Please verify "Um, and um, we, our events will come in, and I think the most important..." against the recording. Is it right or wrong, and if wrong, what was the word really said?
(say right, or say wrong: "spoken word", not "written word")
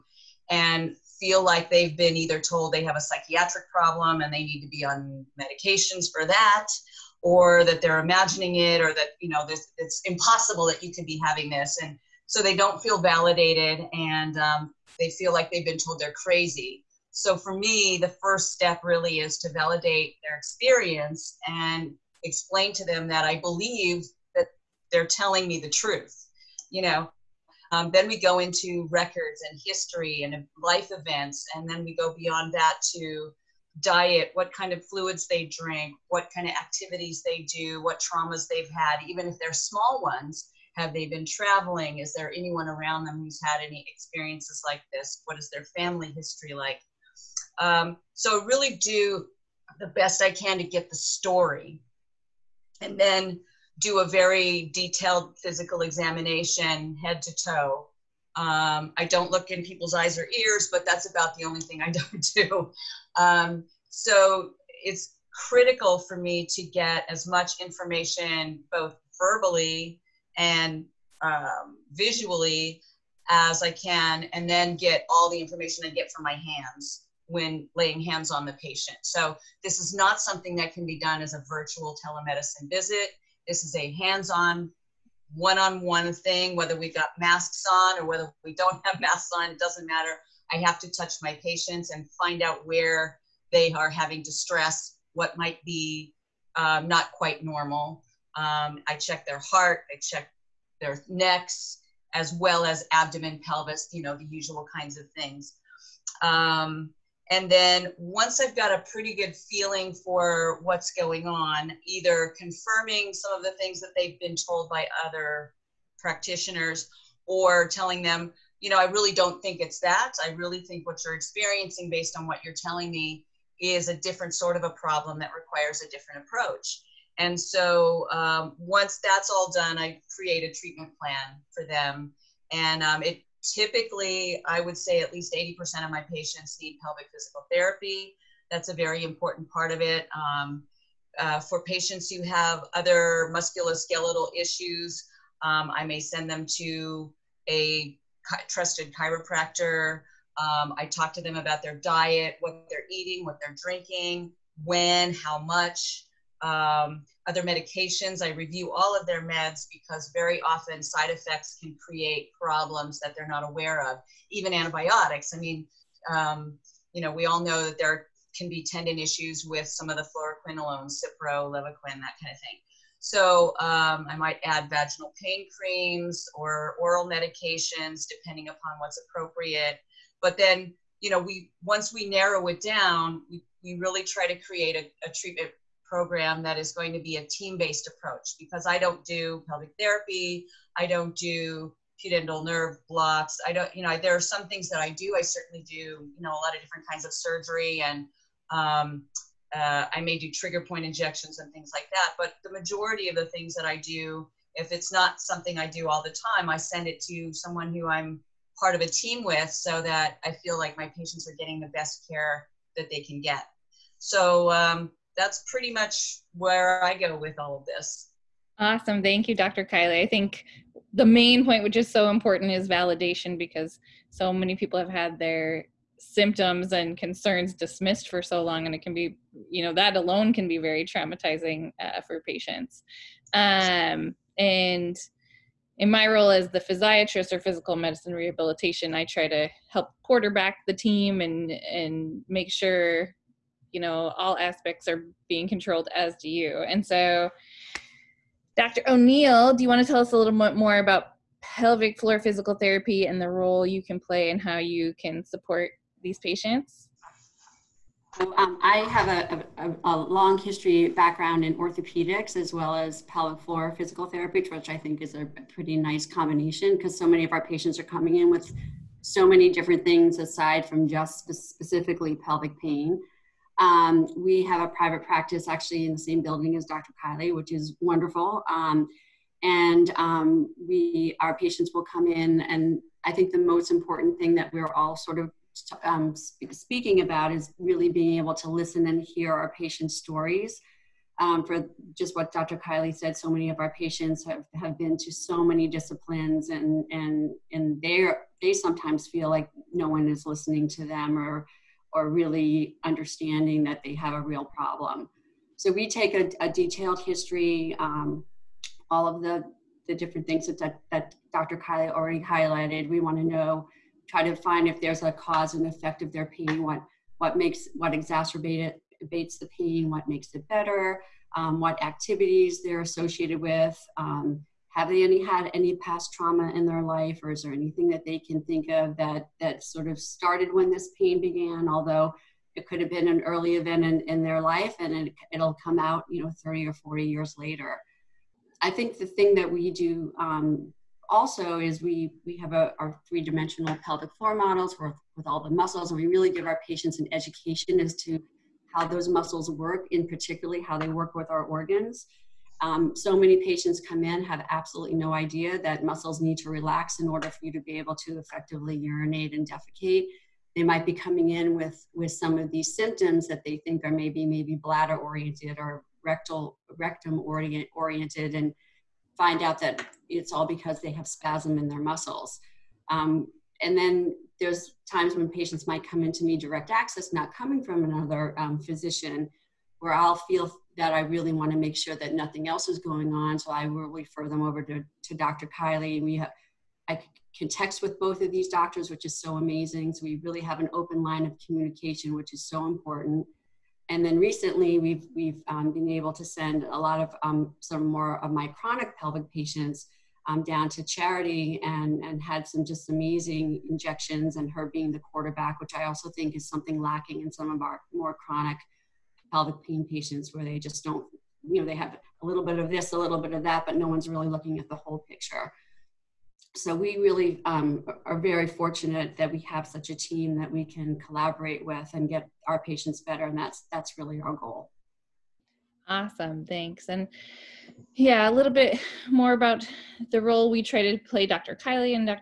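wrong: "patients", not "events".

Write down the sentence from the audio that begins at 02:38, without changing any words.
I review all of their meds because very often side effects can create problems that they're not aware of.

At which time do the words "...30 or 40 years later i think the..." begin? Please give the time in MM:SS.
05:36.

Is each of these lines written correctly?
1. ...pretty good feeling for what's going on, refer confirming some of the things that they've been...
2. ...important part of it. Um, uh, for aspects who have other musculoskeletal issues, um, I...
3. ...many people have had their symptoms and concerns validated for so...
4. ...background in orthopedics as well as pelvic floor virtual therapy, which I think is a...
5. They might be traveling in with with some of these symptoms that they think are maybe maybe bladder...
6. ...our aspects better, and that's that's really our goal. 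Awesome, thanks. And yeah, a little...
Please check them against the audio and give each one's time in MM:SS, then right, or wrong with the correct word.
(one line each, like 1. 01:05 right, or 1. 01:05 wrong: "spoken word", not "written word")
1. 01:48 wrong: "either", not "refer"
2. 02:19 wrong: "patients", not "aspects"
3. 03:44 wrong: "dismissed", not "validated"
4. 04:20 wrong: "physical", not "virtual"
5. 06:00 wrong: "coming", not "traveling"
6. 07:02 wrong: "patients", not "aspects".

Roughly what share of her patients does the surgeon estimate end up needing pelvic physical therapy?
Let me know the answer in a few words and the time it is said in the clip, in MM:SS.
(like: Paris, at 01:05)
80%, at 02:15.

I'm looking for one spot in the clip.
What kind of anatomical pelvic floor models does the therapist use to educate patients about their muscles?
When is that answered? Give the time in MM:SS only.
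05:43.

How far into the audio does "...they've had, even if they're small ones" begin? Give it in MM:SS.
00:38.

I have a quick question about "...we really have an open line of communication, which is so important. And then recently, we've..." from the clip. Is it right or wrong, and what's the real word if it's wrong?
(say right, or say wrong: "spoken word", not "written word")
right.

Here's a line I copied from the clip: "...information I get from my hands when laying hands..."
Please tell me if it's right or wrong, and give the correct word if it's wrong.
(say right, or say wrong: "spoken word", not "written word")
right.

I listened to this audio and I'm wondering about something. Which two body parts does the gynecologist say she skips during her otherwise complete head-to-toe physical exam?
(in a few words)
eyes or ears.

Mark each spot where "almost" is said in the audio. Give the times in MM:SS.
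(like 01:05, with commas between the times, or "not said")
not said.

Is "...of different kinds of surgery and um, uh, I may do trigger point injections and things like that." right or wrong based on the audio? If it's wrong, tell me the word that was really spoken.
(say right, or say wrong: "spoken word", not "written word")
right.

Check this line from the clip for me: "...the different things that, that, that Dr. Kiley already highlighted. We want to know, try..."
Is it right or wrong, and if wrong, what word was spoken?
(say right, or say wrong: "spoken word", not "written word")
right.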